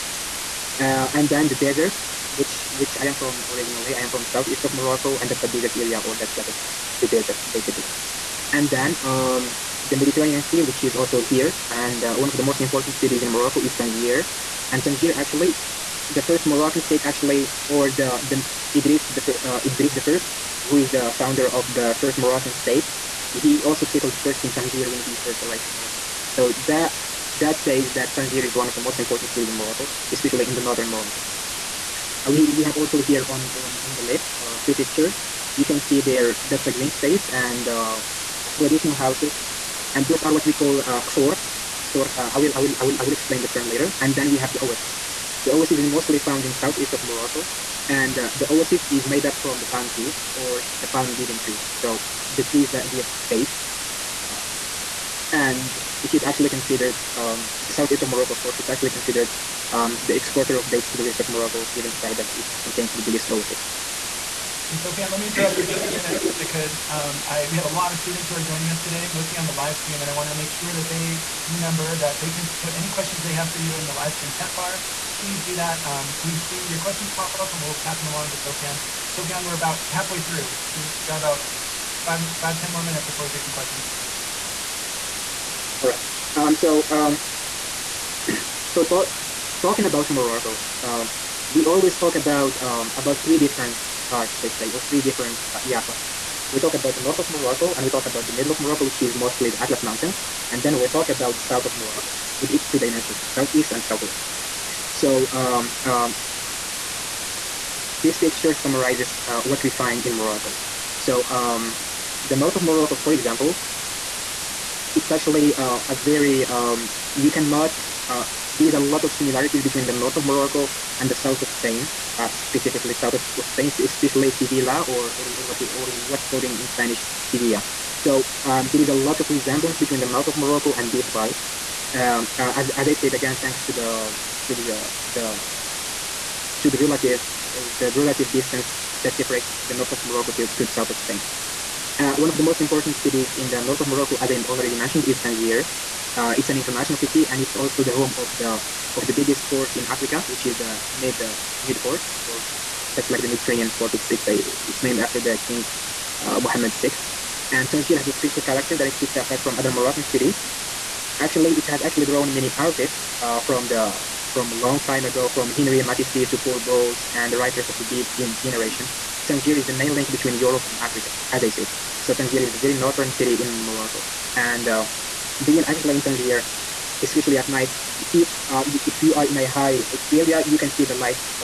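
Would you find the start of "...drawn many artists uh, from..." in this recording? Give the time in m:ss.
2:42.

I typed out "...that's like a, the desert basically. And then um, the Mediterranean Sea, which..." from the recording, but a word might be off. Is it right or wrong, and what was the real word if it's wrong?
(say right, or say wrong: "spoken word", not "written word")
right.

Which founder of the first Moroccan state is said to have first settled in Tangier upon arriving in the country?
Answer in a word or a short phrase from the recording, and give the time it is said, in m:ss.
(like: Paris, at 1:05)
Idris the First, at 0:19.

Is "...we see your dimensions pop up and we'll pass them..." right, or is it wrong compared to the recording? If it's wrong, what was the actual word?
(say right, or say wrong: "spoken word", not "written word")
wrong: "questions", not "dimensions".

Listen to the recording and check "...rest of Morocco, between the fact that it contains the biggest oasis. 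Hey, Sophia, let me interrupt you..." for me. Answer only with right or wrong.
wrong.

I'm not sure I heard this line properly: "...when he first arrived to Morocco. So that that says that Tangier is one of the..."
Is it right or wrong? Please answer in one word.
right.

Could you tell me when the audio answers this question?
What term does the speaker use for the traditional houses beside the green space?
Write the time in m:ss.
0:41.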